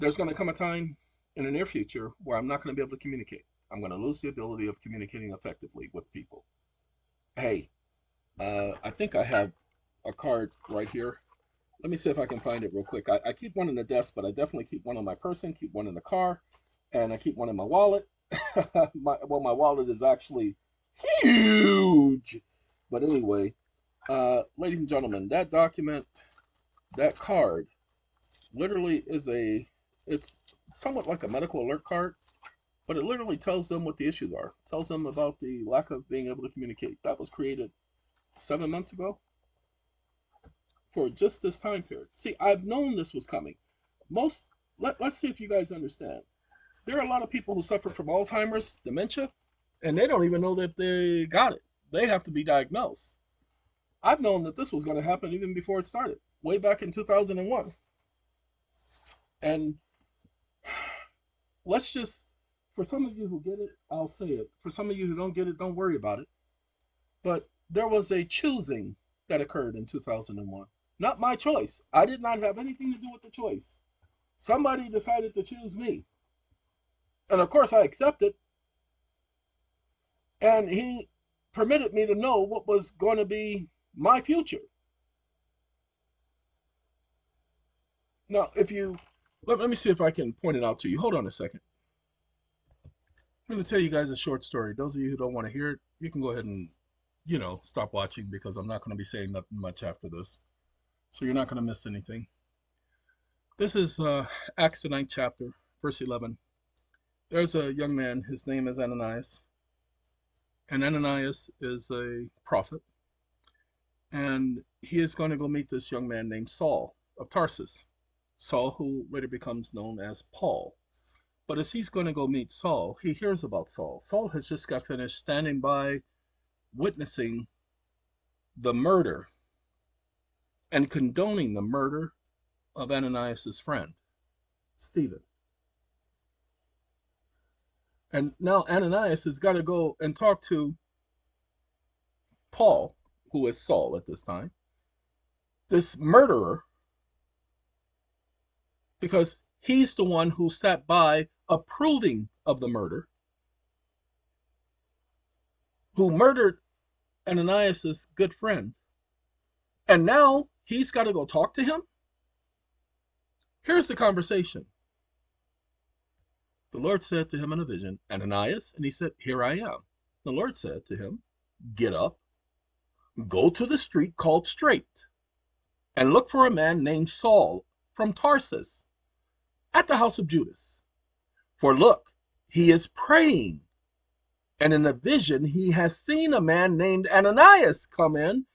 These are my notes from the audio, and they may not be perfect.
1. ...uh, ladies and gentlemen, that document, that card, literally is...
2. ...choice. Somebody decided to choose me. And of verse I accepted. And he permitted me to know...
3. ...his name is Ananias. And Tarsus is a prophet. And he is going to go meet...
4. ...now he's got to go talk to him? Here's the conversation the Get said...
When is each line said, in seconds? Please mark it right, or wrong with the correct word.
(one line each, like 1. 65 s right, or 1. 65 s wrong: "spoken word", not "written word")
1. 24 s right
2. 73 s wrong: "course", not "verse"
3. 108 s wrong: "Ananias", not "Tarsus"
4. 160 s wrong: "Lord", not "Get".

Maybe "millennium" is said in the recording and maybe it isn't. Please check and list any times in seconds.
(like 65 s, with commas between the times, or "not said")
not said.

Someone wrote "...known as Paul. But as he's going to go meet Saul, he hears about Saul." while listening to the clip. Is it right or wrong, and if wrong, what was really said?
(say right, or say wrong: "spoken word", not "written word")
right.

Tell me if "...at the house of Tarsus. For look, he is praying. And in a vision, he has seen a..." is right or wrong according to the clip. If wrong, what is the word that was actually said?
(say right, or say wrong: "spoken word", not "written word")
wrong: "Judas", not "Tarsus".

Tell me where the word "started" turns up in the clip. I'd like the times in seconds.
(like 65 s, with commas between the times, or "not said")
55 s.